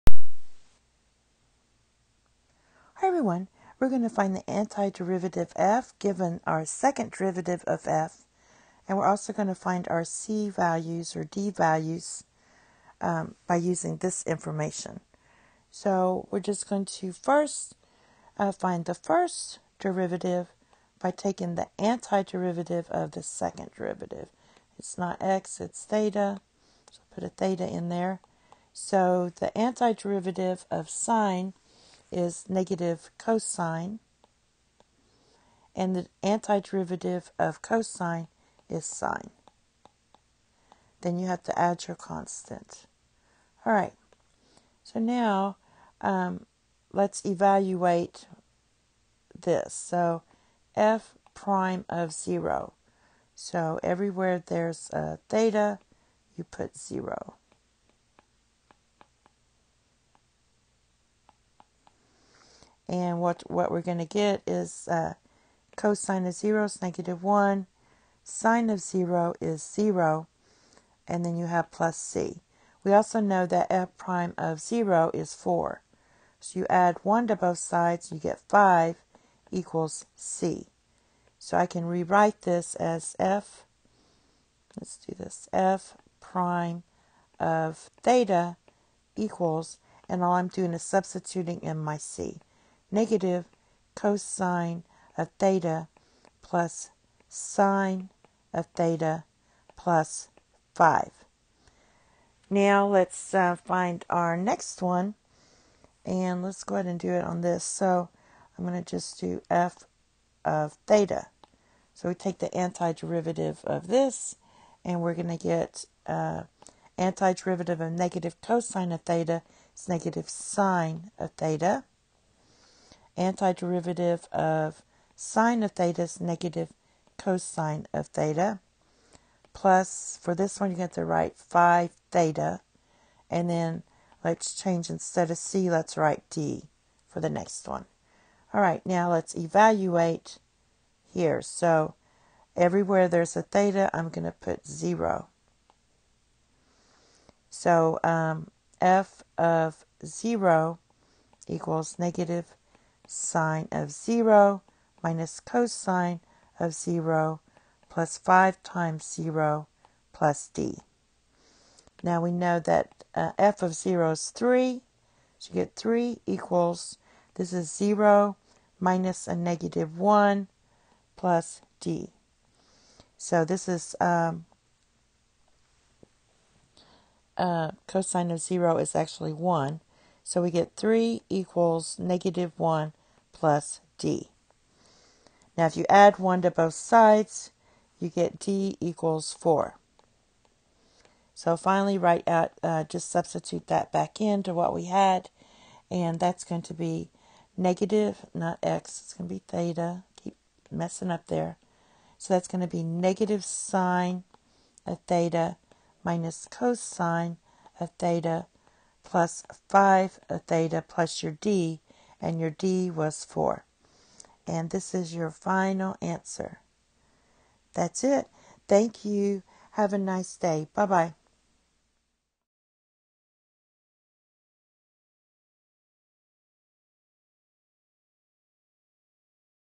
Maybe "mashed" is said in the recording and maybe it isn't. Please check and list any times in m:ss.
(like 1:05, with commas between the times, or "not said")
not said.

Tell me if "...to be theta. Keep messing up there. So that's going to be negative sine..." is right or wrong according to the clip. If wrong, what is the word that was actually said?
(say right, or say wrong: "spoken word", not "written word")
right.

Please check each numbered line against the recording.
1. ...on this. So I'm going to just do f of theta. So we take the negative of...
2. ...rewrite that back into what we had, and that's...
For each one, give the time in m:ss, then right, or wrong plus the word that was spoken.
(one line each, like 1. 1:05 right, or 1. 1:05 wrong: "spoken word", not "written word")
1. 1:47 wrong: "antiderivative", not "negative"
2. 3:13 wrong: "substitute", not "rewrite".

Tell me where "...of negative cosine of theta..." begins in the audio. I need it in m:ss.
1:57.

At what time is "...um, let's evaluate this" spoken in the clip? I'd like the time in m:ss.
0:46.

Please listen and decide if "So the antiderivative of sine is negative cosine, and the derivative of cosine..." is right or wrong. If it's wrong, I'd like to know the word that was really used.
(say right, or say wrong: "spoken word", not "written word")
wrong: "antiderivative", not "derivative".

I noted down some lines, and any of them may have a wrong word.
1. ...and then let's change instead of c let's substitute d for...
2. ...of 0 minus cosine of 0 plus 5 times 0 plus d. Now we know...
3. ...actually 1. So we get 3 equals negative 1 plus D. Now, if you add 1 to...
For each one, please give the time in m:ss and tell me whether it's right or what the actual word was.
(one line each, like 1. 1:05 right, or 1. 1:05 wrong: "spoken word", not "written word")
1. 2:13 wrong: "write", not "substitute"
2. 2:33 right
3. 2:58 right.